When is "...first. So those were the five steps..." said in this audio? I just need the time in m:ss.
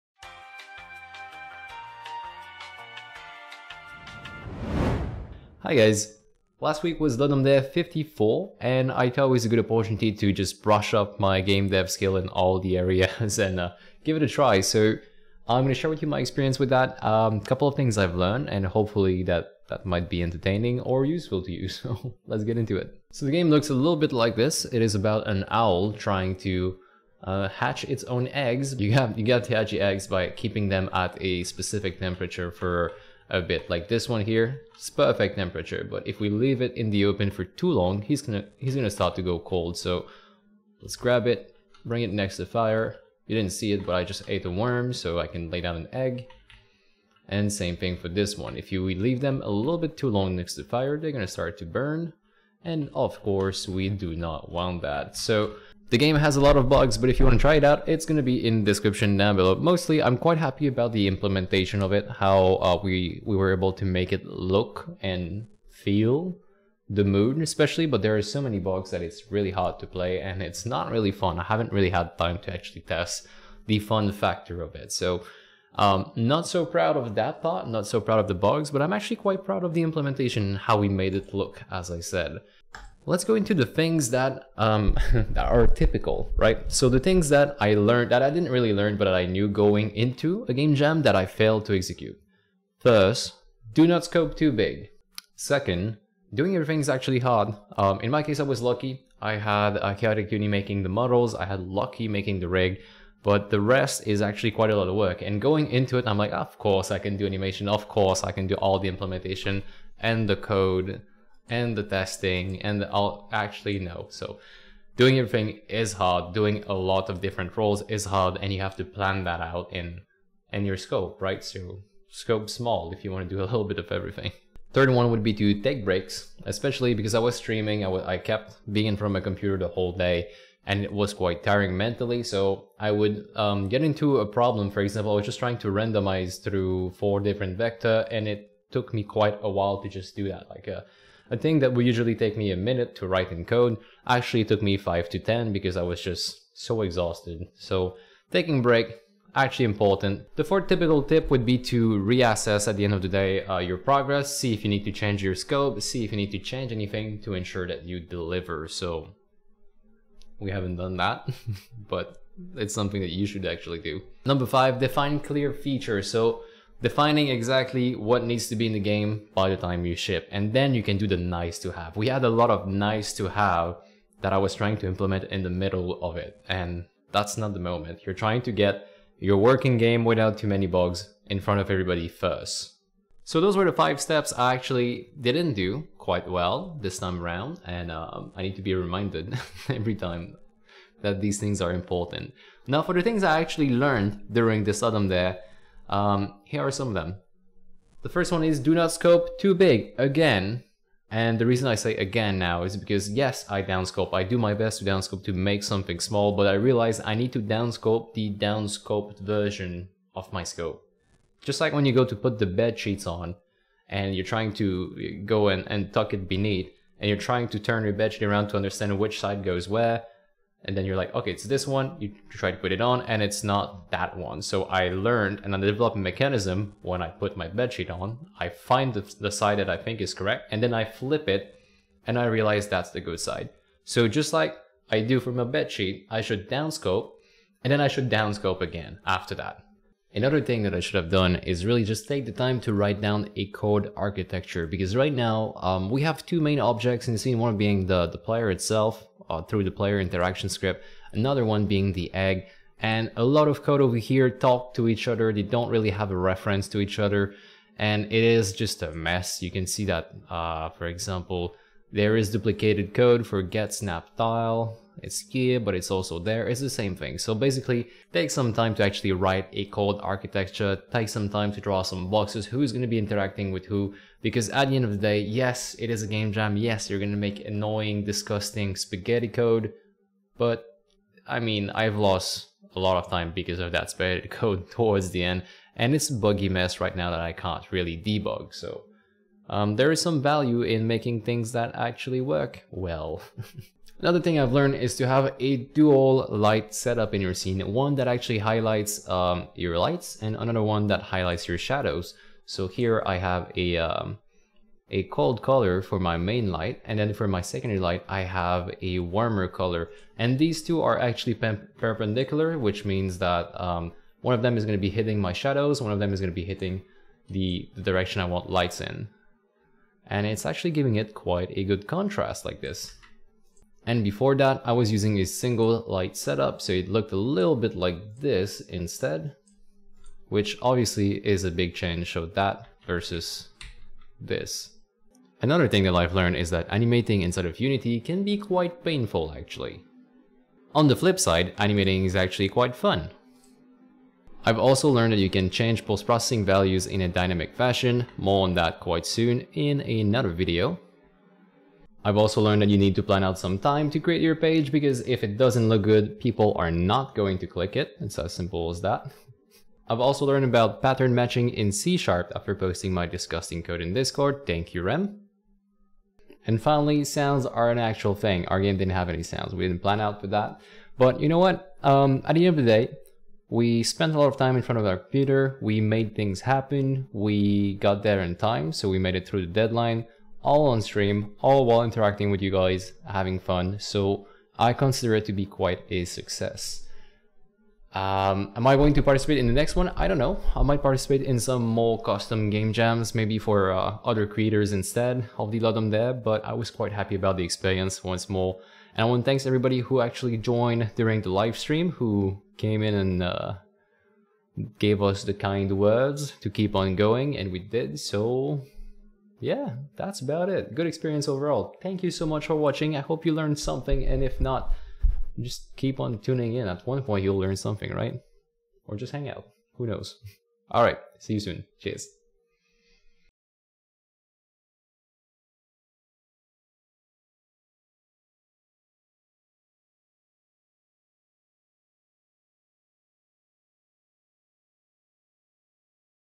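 3:02.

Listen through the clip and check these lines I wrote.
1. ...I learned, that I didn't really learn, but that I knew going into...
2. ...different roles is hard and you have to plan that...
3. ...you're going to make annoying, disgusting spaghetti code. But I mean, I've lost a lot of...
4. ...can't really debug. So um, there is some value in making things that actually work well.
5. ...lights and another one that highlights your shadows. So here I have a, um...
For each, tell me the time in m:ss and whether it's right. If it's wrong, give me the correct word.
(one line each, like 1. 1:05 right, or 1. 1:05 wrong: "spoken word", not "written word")
1. 1:27 right
2. 1:57 right
3. 4:36 right
4. 4:47 right
5. 4:59 right.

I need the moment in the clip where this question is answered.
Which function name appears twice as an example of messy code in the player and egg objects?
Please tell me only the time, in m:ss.
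4:23.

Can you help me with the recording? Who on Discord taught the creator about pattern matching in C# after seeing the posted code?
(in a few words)
Rem.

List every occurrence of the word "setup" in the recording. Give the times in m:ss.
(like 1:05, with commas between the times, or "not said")
4:56, 5:26.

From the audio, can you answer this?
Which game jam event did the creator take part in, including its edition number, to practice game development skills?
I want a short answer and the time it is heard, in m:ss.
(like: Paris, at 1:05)
Ludum Dare 54, at 0:07.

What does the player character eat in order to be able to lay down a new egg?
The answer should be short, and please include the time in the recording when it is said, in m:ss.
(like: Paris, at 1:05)
A worm, at 0:44.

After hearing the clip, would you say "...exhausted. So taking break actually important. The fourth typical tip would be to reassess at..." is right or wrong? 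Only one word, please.
right.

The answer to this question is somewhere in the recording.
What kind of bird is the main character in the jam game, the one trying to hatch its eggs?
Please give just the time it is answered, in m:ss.
0:25.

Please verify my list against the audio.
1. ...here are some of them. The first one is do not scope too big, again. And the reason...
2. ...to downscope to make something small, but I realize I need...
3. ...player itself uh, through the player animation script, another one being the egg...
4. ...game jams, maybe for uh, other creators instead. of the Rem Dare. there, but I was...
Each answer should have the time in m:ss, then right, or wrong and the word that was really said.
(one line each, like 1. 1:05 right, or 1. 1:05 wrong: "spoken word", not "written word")
1. 3:16 right
2. 3:24 right
3. 4:08 wrong: "interaction", not "animation"
4. 6:32 wrong: "Ludum", not "Rem".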